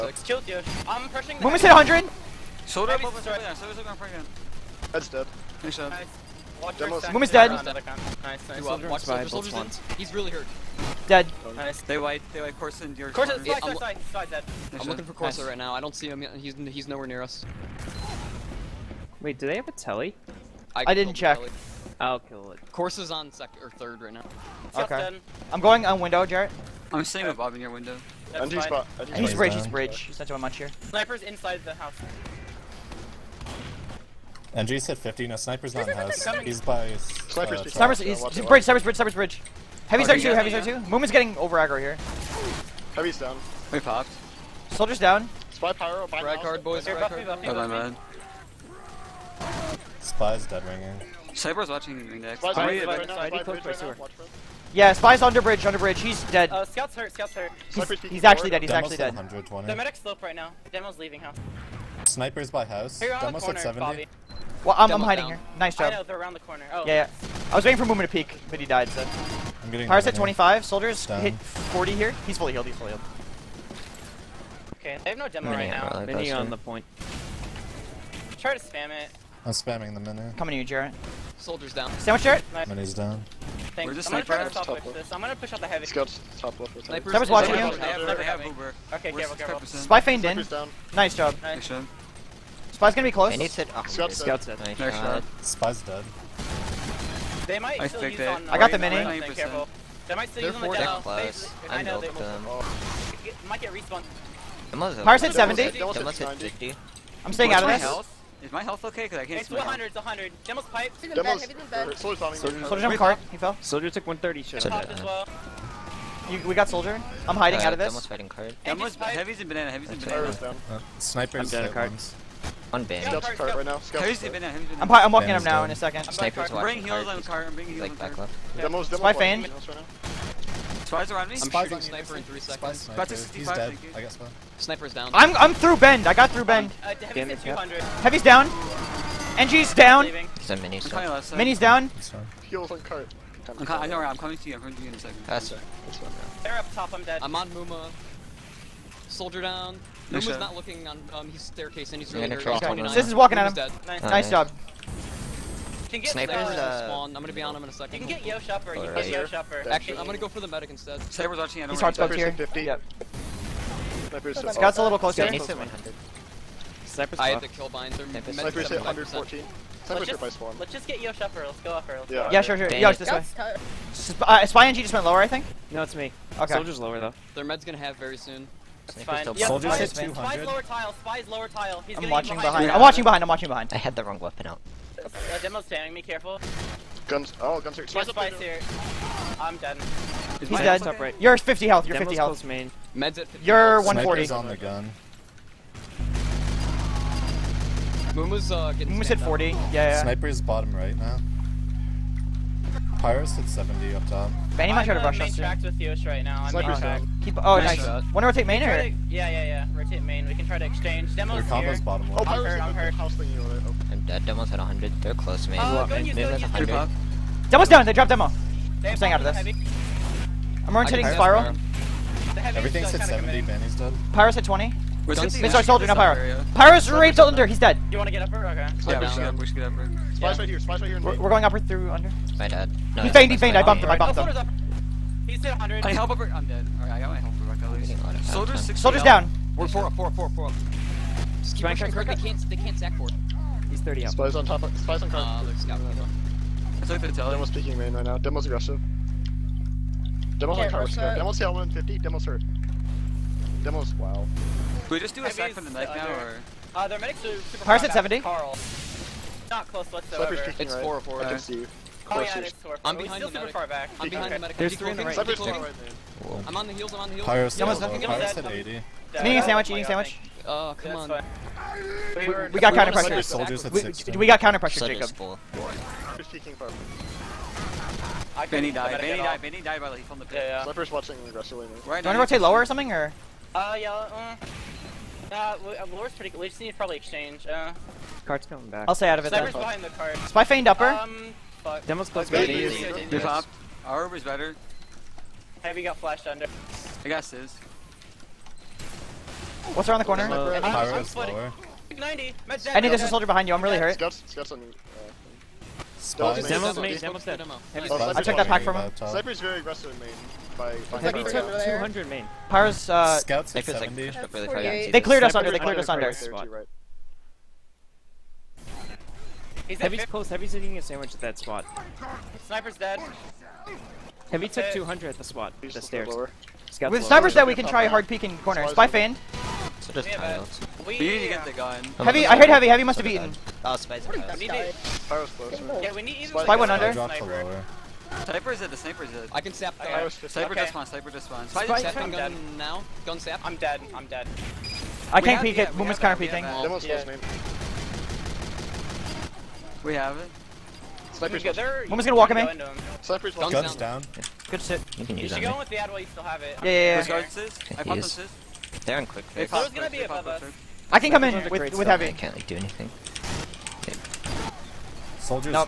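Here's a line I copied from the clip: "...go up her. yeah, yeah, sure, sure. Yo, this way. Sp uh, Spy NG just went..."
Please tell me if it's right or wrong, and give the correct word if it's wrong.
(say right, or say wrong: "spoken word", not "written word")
right.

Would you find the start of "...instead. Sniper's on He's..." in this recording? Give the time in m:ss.
2:40.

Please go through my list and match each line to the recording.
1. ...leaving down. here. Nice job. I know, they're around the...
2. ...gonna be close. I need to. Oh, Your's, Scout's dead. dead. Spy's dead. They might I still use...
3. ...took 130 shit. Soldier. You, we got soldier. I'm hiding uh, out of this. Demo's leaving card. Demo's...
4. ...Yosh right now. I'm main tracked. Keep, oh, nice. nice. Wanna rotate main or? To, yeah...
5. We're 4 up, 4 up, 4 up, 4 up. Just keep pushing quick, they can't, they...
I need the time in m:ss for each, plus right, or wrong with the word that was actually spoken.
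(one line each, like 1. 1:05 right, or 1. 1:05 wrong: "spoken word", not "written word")
1. 1:05 wrong: "hiding", not "leaving"
2. 1:32 wrong: "Scout", not "Your"
3. 1:53 wrong: "fighting", not "leaving"
4. 3:25 right
5. 3:59 right.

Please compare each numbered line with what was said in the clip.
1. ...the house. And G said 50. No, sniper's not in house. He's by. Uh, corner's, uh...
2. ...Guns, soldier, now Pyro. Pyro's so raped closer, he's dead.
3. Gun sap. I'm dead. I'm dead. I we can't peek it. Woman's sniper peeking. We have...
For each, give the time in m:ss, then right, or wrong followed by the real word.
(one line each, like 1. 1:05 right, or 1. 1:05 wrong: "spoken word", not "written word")
1. 0:31 wrong: "sniper", not "corner"
2. 3:45 wrong: "under", not "closer"
3. 5:43 wrong: "counter", not "sniper".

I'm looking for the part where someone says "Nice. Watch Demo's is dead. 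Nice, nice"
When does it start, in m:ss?
0:05.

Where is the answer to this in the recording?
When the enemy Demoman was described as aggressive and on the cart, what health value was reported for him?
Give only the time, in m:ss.
4:11.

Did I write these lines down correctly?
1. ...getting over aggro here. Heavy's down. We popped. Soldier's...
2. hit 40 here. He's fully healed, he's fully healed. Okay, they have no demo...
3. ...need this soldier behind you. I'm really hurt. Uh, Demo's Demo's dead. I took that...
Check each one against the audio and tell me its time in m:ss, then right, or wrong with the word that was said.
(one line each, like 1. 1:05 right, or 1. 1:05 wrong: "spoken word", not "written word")
1. 0:41 right
2. 1:11 right
3. 5:02 right.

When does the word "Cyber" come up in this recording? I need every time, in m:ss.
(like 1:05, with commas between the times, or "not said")
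0:51.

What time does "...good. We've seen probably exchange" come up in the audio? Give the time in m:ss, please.
4:46.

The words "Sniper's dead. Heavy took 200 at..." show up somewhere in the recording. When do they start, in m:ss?
5:22.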